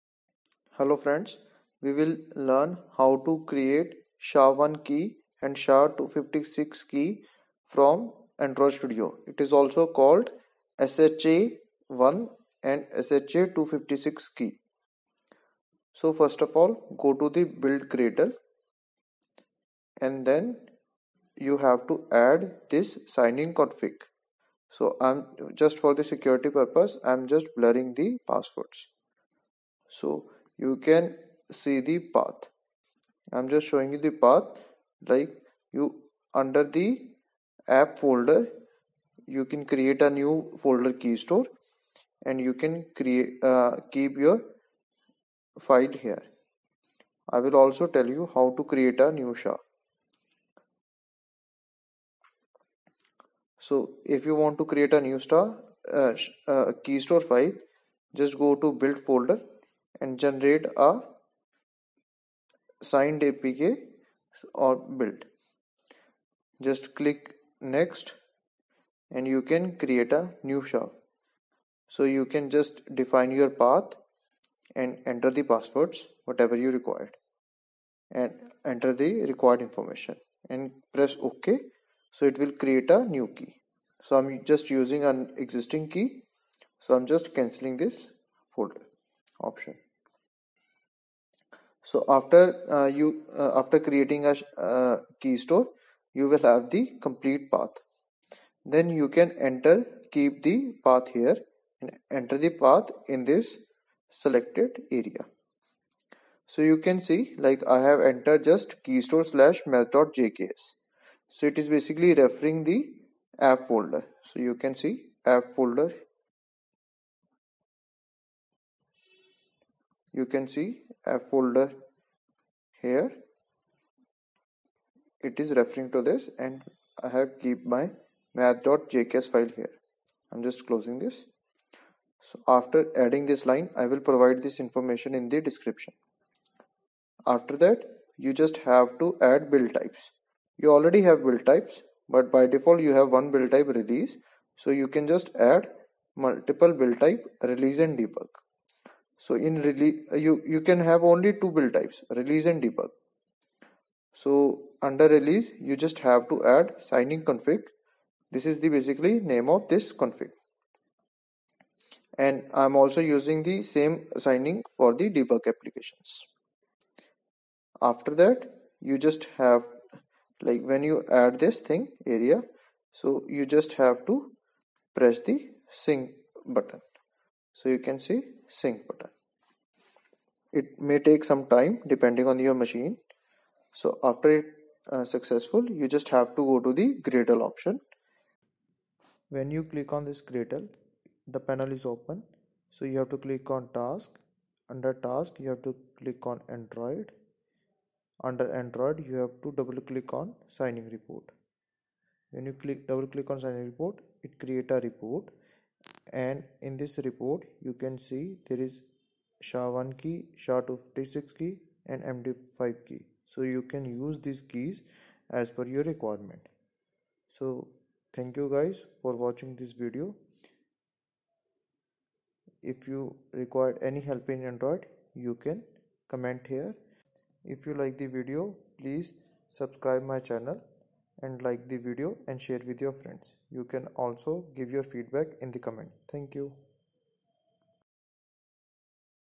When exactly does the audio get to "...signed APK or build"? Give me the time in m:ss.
1:02.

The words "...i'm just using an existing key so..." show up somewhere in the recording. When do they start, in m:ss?
1:24.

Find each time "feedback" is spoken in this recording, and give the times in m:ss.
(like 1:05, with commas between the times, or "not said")
3:54.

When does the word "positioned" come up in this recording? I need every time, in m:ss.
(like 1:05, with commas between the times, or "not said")
not said.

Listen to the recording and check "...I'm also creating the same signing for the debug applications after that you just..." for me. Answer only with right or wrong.
wrong.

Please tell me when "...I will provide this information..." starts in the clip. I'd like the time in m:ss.
2:13.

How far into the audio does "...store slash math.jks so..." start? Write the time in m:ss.
1:49.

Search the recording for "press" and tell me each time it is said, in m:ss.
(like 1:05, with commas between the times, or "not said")
1:20, 2:54.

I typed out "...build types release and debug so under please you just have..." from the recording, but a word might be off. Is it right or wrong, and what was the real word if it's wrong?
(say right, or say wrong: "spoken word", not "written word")
wrong: "release", not "please".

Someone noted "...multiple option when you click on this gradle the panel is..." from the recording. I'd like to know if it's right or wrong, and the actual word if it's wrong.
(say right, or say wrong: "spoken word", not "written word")
wrong: "gradle", not "multiple".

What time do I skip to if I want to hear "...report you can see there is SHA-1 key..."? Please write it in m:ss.
3:27.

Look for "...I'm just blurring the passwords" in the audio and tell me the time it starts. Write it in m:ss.
0:27.